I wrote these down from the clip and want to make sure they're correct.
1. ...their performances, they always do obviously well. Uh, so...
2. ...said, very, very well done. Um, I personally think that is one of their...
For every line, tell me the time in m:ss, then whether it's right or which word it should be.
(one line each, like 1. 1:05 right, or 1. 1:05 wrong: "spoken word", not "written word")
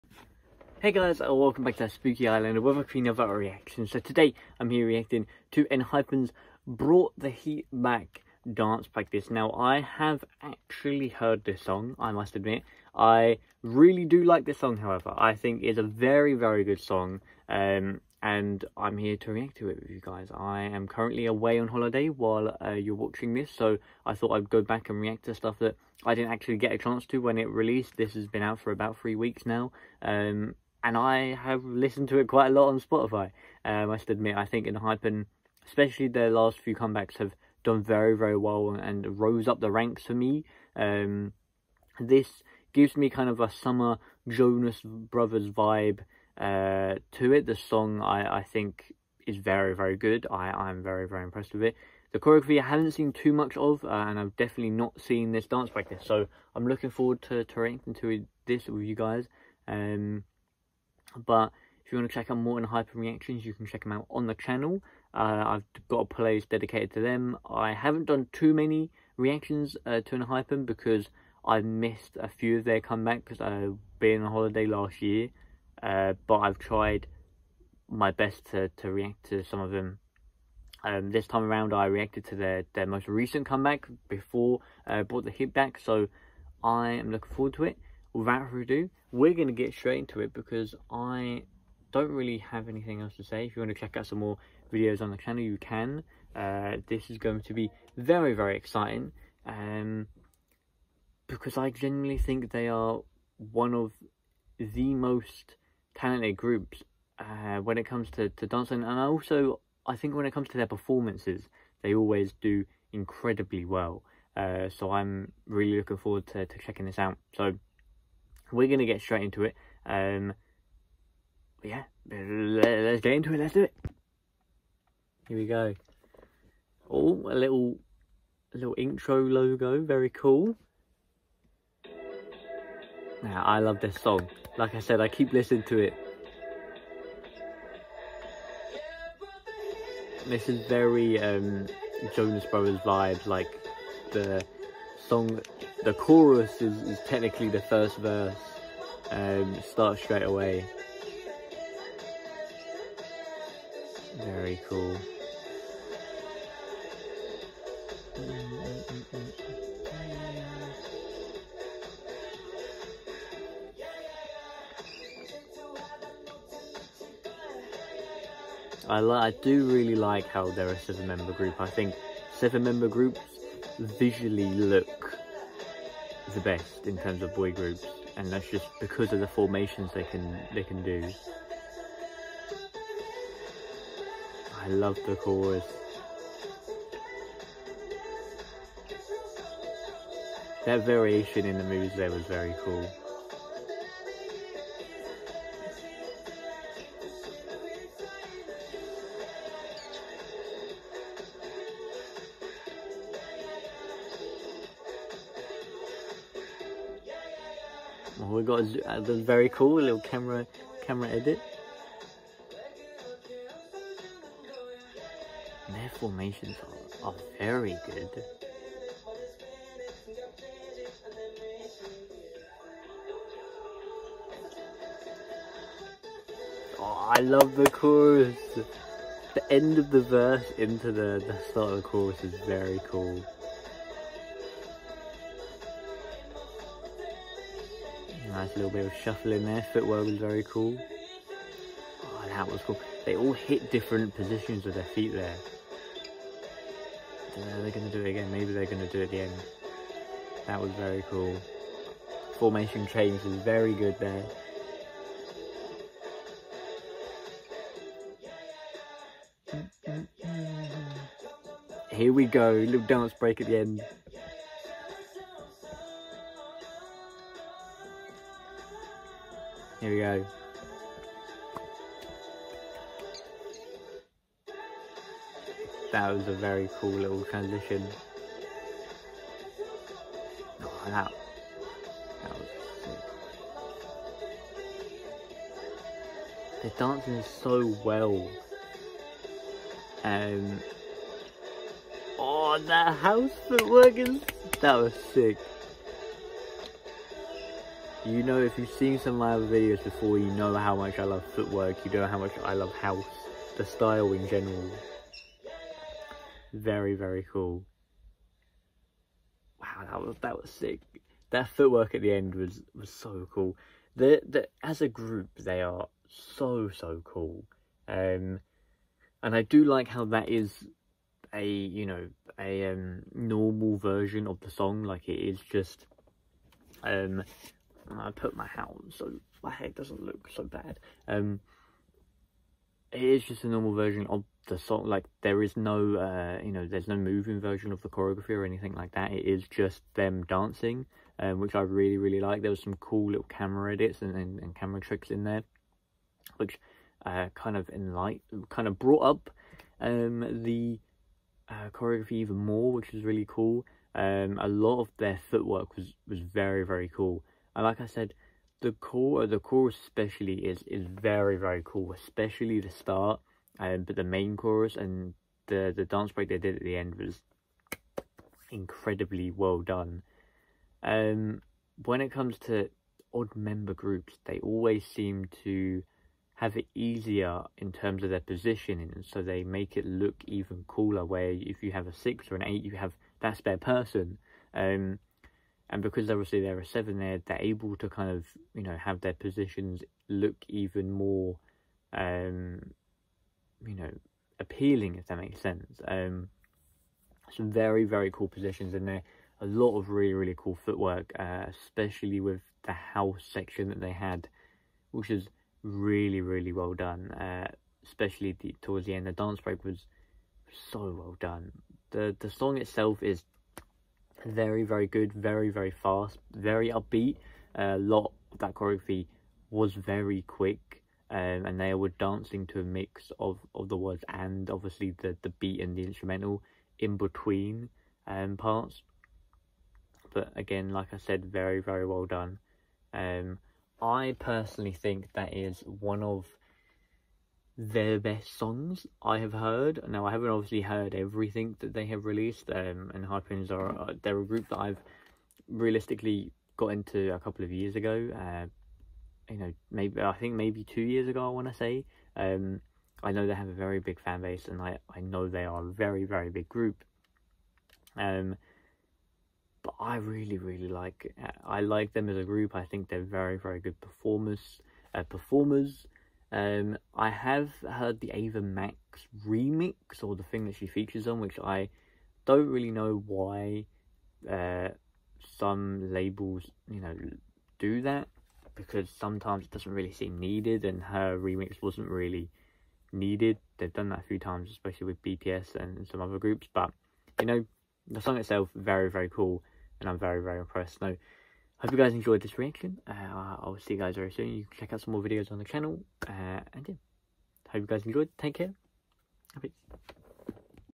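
1. 1:50 wrong: "incredibly", not "obviously"
2. 7:10 right.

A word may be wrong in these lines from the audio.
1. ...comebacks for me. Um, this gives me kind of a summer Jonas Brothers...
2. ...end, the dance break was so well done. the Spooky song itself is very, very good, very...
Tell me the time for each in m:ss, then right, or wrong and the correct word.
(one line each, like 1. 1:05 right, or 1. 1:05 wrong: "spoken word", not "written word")
1. 0:39 wrong: "ranks", not "comebacks"
2. 6:48 wrong: "The", not "Spooky".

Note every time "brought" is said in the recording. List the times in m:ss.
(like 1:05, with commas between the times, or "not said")
0:06, 1:25, 5:48.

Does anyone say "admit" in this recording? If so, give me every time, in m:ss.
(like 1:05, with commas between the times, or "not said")
0:12, 0:34.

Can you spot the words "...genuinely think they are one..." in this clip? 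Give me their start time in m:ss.
1:41.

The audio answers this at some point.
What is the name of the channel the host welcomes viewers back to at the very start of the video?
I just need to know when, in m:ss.
0:01.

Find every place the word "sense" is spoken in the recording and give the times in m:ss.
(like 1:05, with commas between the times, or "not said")
6:35.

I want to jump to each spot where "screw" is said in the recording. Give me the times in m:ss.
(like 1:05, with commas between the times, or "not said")
not said.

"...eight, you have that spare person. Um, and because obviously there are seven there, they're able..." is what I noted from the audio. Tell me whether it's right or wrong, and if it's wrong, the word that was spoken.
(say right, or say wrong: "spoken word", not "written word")
right.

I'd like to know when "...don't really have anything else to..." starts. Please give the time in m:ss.
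1:31.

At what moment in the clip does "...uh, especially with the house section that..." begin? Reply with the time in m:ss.
6:41.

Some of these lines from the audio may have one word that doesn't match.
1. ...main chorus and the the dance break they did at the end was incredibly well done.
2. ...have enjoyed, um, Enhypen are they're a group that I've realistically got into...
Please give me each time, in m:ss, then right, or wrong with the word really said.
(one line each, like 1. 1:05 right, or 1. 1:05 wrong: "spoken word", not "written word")
1. 6:04 right
2. 7:21 wrong: "released", not "enjoyed".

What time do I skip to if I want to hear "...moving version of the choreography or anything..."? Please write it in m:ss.
5:36.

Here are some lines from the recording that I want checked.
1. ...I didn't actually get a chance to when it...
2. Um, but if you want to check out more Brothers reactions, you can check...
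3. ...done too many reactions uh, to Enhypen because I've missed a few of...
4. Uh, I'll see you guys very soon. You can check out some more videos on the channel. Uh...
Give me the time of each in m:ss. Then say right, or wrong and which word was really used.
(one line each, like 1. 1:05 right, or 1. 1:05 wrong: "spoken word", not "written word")
1. 0:26 right
2. 0:59 wrong: "Enhypen", not "Brothers"
3. 1:08 right
4. 8:12 right.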